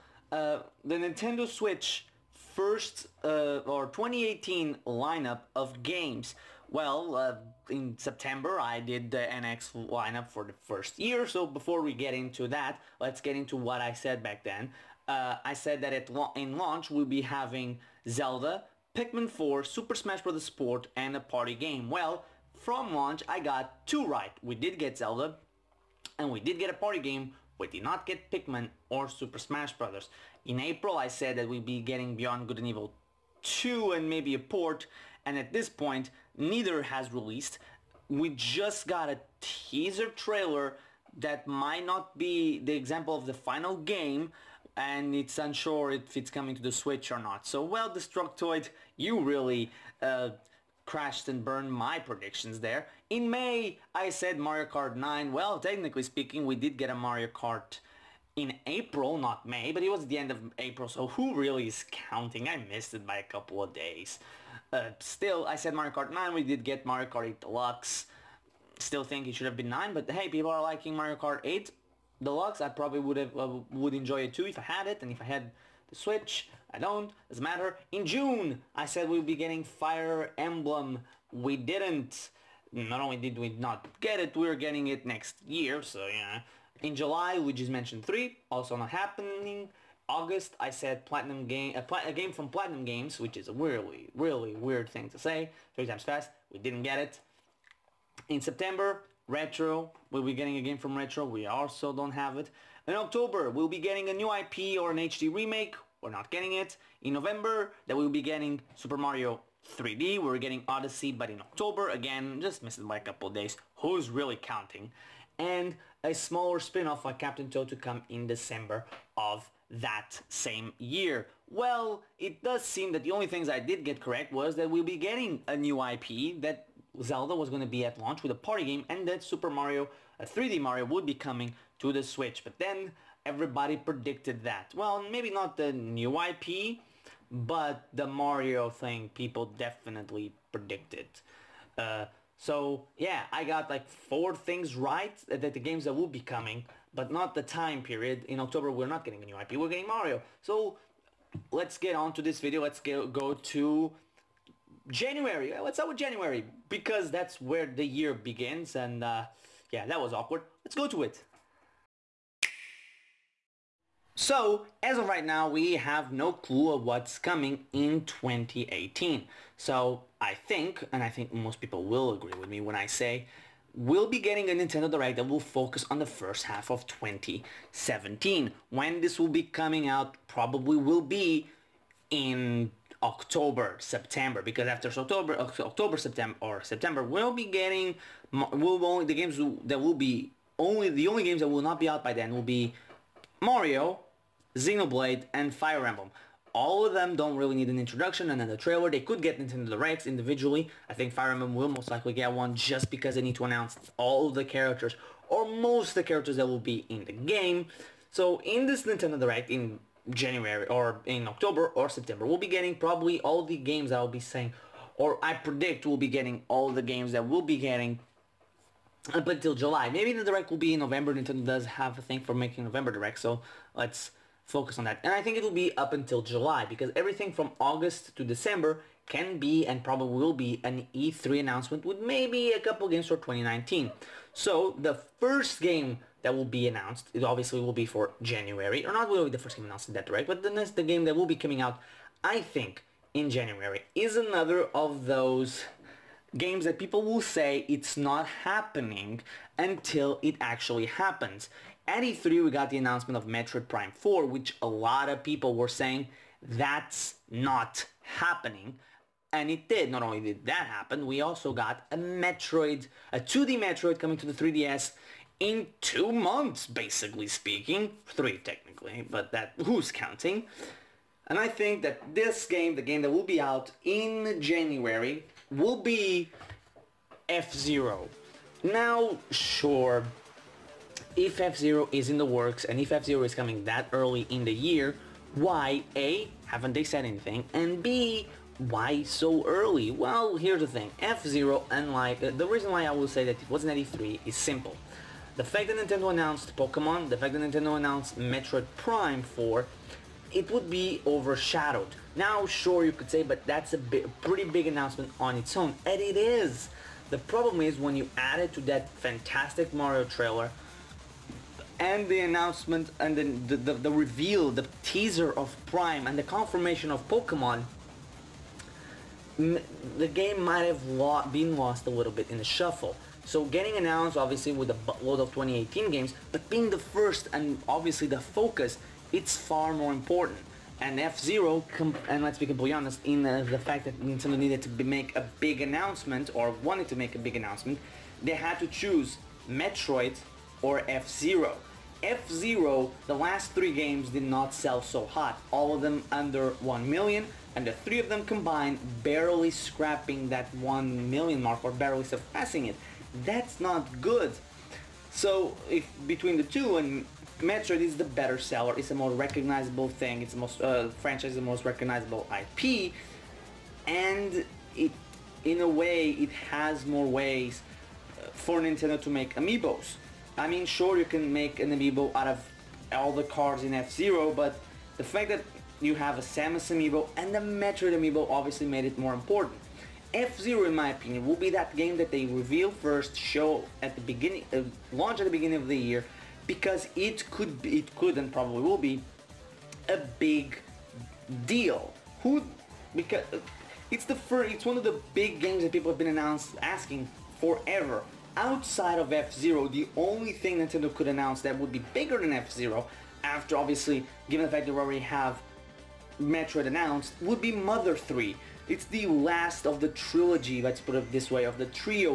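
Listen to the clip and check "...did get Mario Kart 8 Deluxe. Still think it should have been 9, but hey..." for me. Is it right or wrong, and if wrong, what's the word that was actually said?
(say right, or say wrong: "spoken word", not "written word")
right.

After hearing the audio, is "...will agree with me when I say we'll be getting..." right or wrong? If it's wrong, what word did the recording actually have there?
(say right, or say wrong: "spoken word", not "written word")
right.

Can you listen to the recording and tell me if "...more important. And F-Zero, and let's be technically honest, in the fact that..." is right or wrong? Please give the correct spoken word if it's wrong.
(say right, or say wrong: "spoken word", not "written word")
wrong: "completely", not "technically".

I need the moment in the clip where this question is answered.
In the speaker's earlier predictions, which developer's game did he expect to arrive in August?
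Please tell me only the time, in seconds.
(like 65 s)
92 s.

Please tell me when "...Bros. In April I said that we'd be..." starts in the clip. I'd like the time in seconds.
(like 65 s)
29 s.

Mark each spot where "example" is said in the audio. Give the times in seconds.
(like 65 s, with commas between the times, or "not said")
42 s.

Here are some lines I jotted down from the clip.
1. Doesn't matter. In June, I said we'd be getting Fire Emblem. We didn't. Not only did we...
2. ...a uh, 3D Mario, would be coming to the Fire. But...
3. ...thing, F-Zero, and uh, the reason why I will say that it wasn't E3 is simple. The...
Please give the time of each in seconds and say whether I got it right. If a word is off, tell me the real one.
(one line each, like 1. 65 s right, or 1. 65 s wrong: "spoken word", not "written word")
1. 77 s right
2. 130 s wrong: "Switch", not "Fire"
3. 290 s right.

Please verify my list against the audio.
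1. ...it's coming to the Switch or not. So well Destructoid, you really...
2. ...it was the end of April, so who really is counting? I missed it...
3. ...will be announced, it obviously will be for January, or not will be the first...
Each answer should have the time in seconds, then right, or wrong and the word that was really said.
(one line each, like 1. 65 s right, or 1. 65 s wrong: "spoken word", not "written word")
1. 46 s right
2. 59 s right
3. 236 s right.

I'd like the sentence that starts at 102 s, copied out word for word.
In October, we'll be getting a new IP or an HD remake.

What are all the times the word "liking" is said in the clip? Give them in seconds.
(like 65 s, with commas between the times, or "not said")
70 s.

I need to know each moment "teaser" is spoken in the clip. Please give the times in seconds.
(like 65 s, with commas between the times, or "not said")
39 s, 314 s.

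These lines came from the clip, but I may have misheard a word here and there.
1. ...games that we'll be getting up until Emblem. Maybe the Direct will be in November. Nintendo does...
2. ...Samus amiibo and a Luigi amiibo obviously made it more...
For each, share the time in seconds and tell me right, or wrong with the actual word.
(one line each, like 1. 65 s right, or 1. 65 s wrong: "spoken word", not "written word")
1. 216 s wrong: "July", not "Emblem"
2. 376 s wrong: "Metroid", not "Luigi".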